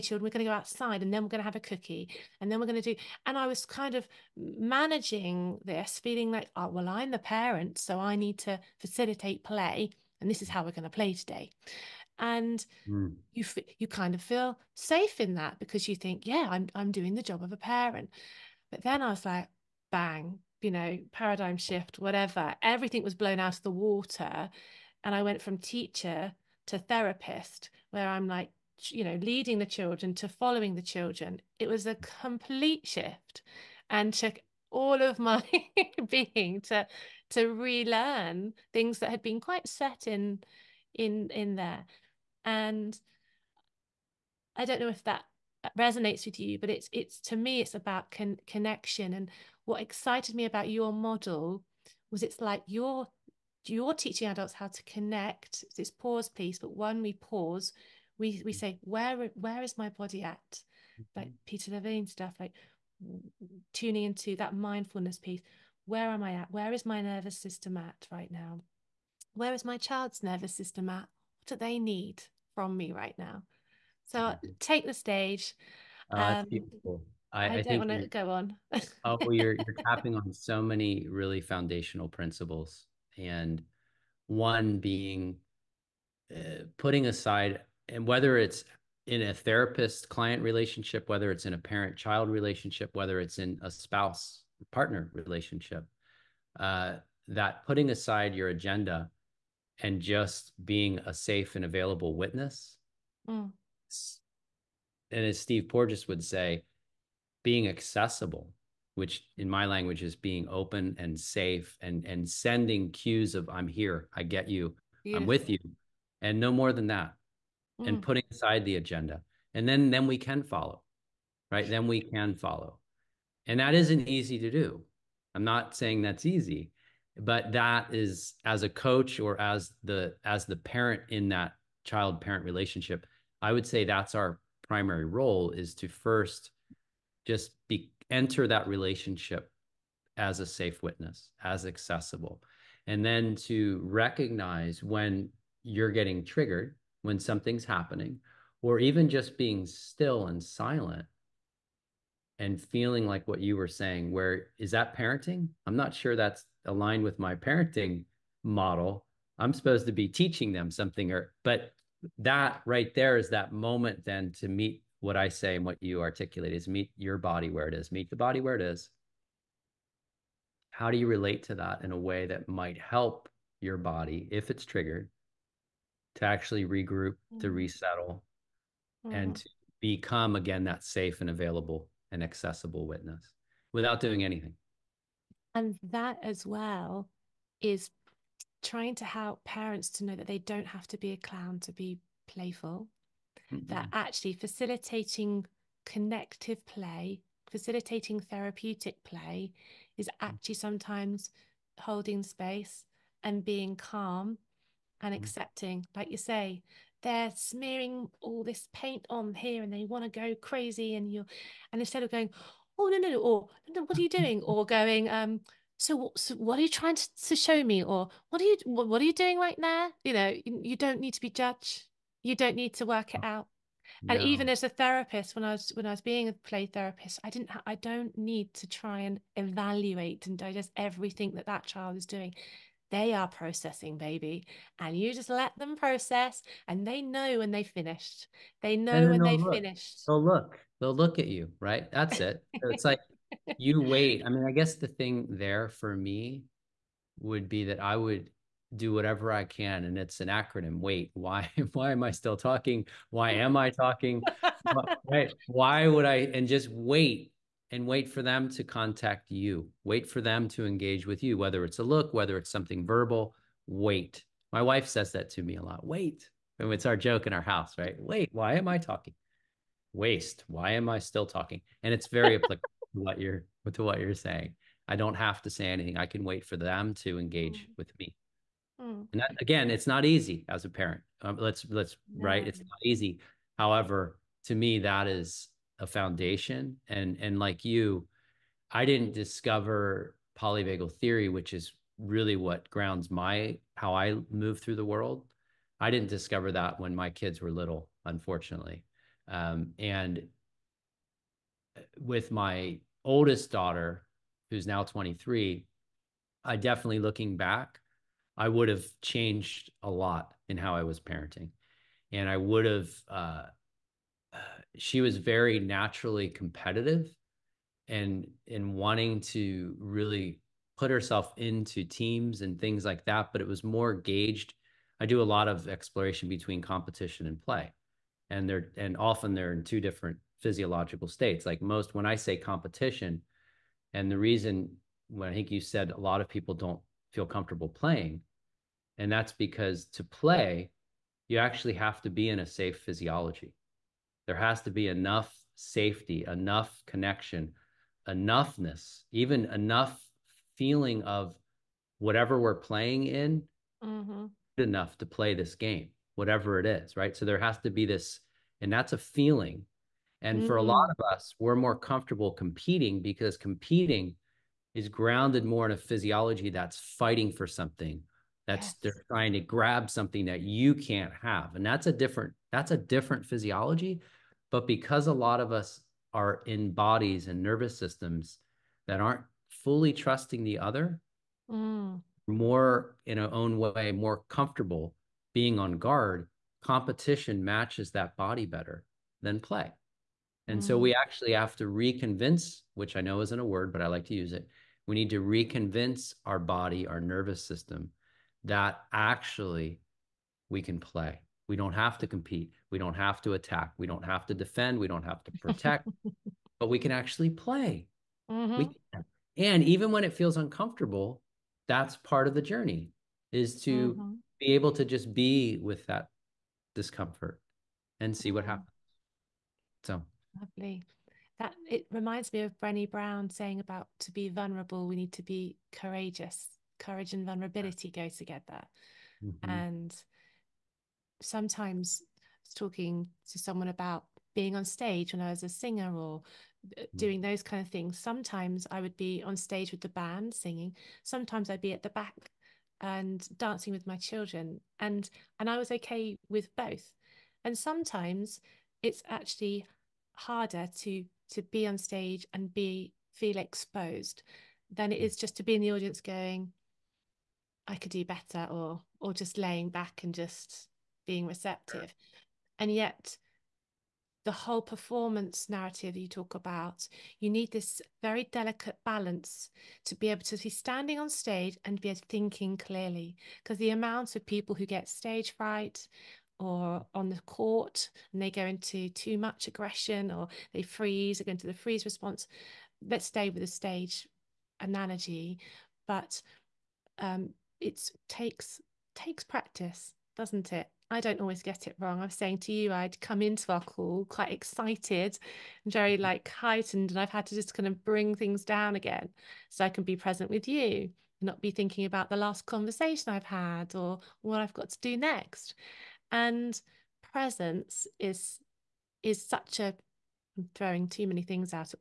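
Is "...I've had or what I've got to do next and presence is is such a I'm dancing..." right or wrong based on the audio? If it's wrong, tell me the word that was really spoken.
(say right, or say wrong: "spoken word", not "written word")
wrong: "throwing", not "dancing".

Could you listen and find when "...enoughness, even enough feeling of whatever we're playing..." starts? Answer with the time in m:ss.
5:48.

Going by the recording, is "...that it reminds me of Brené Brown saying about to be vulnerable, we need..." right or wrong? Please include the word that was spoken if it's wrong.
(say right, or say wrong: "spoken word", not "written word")
right.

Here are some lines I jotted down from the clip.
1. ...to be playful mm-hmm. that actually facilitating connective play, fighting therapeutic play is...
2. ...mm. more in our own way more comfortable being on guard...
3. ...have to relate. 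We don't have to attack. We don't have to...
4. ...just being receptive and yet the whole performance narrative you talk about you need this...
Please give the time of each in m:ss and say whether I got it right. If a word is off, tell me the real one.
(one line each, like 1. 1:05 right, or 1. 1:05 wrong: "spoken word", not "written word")
1. 3:11 wrong: "facilitating", not "fighting"
2. 6:21 right
3. 6:41 wrong: "compete", not "relate"
4. 7:40 right.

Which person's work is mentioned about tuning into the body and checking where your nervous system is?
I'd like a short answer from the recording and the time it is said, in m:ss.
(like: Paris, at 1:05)
Peter Levine, at 1:01.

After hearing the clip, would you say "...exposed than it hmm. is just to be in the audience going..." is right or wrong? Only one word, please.
right.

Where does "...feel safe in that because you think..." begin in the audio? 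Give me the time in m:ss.
0:14.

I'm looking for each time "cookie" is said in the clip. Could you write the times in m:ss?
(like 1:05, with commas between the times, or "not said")
0:01.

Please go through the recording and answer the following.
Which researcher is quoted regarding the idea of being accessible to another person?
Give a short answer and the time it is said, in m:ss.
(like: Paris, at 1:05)
Steve Porges, at 1:45.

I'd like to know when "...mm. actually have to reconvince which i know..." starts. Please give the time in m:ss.
6:30.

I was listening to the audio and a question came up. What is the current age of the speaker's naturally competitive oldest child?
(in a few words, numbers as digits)
23.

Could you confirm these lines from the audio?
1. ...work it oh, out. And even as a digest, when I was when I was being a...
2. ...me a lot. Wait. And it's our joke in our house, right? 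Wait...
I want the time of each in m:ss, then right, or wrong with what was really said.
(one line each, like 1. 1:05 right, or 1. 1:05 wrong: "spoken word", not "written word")
1. 3:42 wrong: "therapist", not "digest"
2. 4:25 right.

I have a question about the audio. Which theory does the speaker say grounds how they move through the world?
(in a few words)
polyvagal theory.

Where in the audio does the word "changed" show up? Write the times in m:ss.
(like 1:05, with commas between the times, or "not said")
5:09.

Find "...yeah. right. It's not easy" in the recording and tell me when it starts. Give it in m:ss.
4:42.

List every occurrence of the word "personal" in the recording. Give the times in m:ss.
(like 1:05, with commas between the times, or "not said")
not said.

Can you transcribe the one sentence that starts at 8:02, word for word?
Let's stay with the stage analogy, but um, it takes takes practice, doesn't it?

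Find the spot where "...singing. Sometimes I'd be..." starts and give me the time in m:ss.
7:20.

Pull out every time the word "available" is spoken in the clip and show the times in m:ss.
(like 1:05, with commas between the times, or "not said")
1:41, 3:01.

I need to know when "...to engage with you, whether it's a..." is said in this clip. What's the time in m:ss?
4:20.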